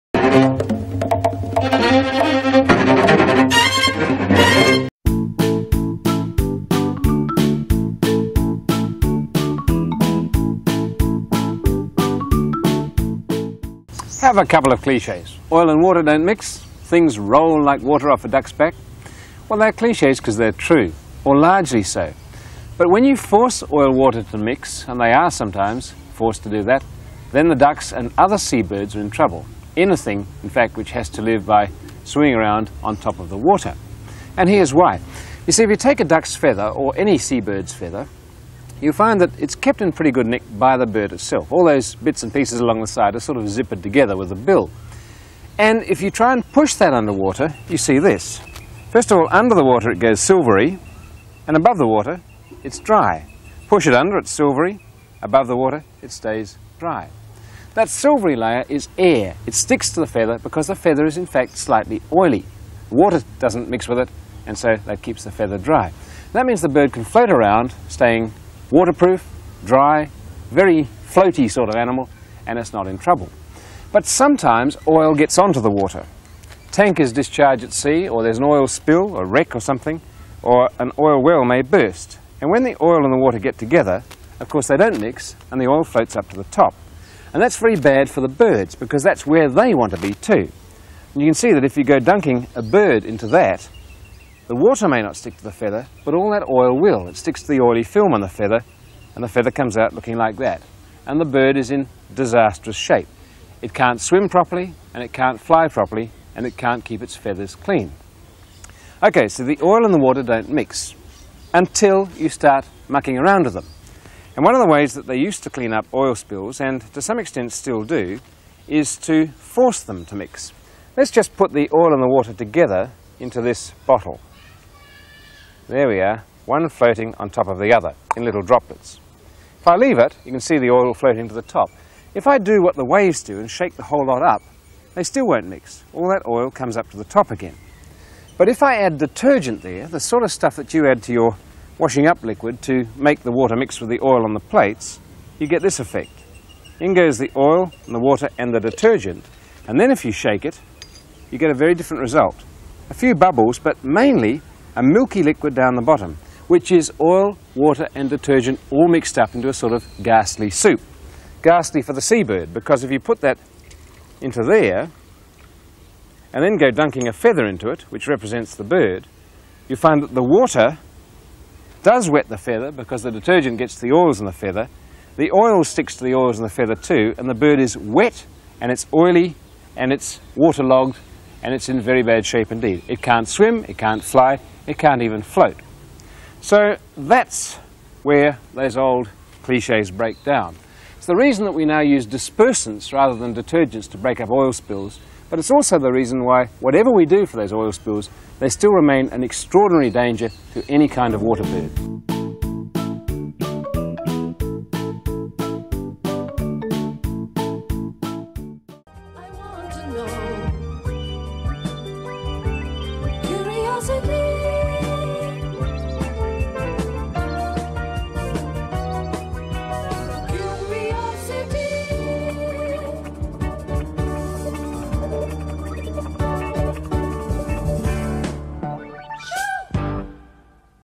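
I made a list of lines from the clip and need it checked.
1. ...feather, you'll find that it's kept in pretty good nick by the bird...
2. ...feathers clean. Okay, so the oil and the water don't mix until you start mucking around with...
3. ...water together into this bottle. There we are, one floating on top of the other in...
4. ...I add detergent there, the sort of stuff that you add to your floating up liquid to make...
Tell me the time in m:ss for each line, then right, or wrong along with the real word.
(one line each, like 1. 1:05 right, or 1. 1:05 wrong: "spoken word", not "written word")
1. 0:37 right
2. 1:47 right
3. 2:02 right
4. 2:18 wrong: "washing", not "floating".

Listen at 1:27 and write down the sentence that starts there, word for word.
And that's very bad for the birds, because that's where they want to be too.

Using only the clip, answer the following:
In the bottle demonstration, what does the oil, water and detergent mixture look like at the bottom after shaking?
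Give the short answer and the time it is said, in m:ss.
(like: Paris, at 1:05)
a milky liquid, at 2:34.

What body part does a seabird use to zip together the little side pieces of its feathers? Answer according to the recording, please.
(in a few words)
the bill.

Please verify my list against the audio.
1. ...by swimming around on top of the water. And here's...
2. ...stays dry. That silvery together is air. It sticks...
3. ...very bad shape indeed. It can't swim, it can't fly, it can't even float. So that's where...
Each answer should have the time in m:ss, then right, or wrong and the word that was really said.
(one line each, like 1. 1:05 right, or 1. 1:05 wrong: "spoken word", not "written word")
1. 0:31 right
2. 0:56 wrong: "layer", not "together"
3. 3:01 right.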